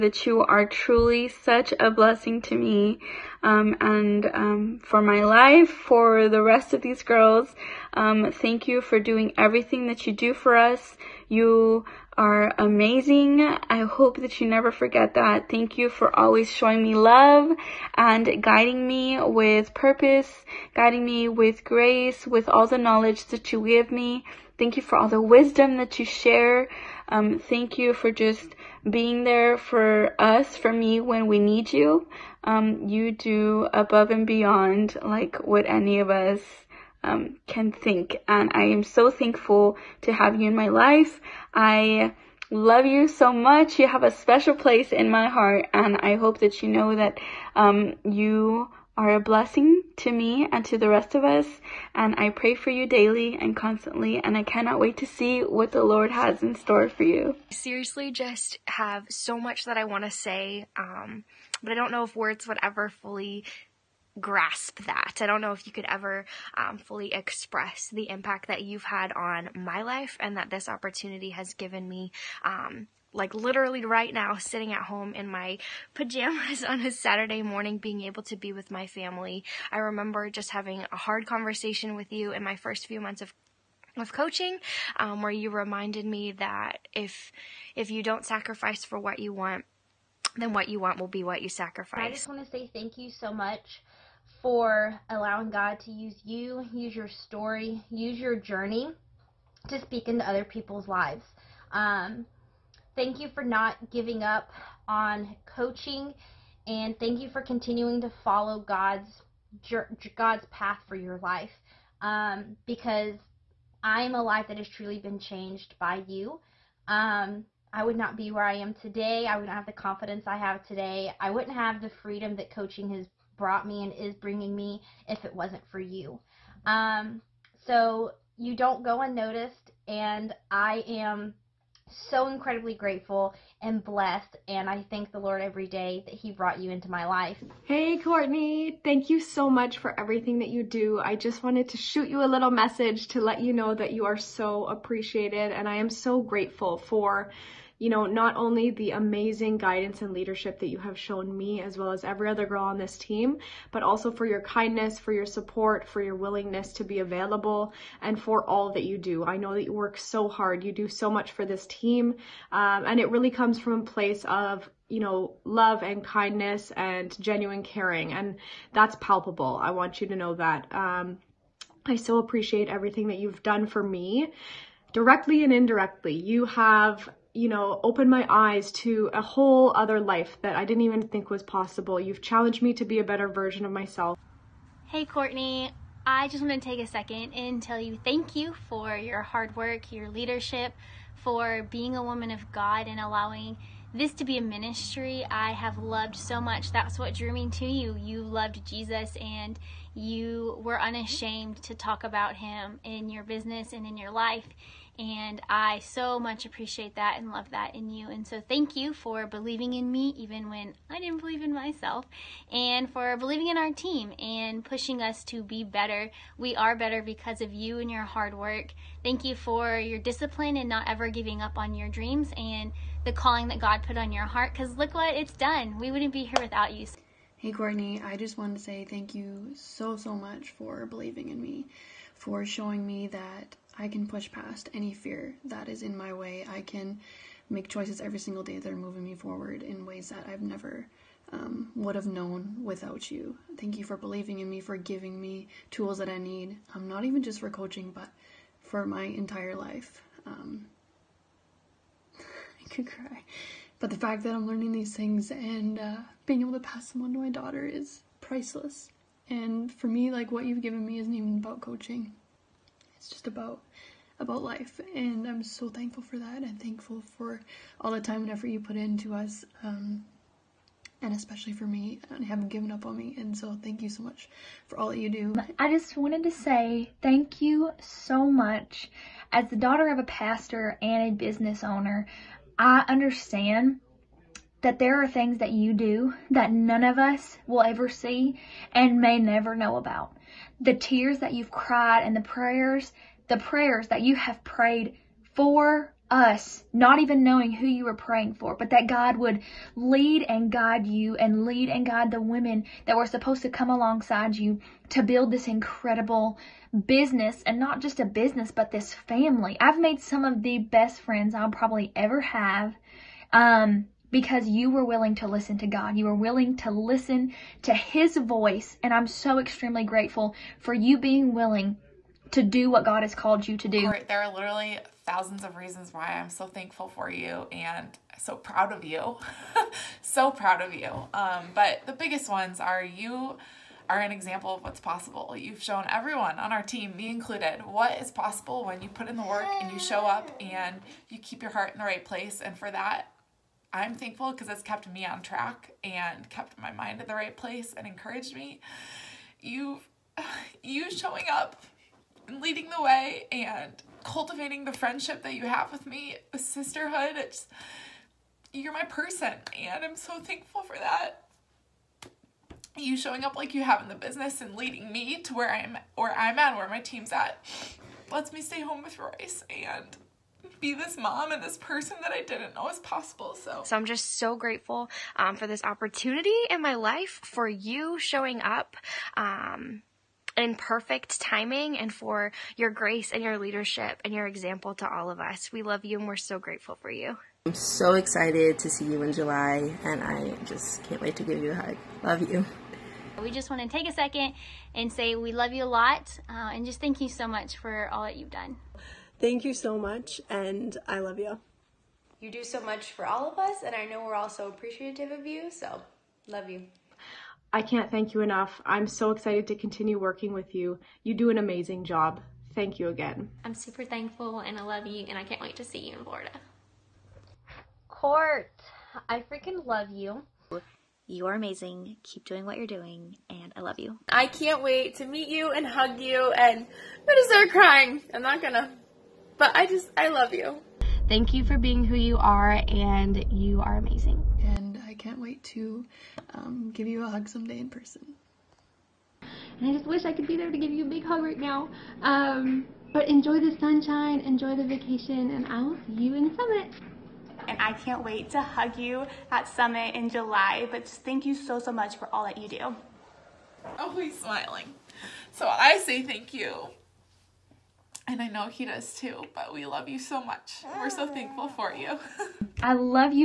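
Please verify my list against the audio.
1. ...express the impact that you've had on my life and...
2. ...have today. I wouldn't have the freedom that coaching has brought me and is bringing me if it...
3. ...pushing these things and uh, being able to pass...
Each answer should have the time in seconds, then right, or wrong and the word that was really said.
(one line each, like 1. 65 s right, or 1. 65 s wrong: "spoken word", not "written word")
1. 67 s right
2. 120 s right
3. 254 s wrong: "learning", not "pushing".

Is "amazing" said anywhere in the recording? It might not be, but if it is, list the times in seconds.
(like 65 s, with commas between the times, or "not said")
12 s, 148 s, 411 s, 421 s, 433 s.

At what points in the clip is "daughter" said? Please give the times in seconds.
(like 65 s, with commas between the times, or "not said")
257 s, 279 s.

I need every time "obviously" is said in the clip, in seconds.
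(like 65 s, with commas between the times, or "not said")
not said.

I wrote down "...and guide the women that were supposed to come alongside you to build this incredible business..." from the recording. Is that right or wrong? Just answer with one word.
right.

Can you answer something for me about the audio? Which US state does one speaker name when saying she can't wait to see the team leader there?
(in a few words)
Florida.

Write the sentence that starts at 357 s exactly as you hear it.
It's you're my person and I'm so thankful for that.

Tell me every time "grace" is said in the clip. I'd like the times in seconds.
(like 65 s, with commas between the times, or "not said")
21 s, 382 s.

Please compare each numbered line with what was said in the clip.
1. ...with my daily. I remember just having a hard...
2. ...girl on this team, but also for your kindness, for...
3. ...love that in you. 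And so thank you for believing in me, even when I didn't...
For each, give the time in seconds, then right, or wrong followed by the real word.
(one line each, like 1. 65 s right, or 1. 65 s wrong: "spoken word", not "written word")
1. 78 s wrong: "family", not "daily"
2. 152 s right
3. 207 s right.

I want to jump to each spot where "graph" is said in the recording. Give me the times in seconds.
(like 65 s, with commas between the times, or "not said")
not said.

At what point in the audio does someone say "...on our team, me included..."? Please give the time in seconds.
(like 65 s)
336 s.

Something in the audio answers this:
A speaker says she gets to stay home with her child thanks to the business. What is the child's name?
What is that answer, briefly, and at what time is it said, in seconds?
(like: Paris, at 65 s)
Royce, at 368 s.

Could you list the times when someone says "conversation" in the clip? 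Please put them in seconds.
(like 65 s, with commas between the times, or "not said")
81 s.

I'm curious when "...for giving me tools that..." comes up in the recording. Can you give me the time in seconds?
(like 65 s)
244 s.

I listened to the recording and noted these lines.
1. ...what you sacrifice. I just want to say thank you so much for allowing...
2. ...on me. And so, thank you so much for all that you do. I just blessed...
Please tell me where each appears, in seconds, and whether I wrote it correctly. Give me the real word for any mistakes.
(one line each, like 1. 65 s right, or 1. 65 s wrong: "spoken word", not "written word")
1. 91 s right
2. 272 s wrong: "wanted", not "blessed".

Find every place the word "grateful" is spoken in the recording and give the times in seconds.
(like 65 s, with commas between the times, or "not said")
132 s, 146 s, 319 s, 374 s, 386 s.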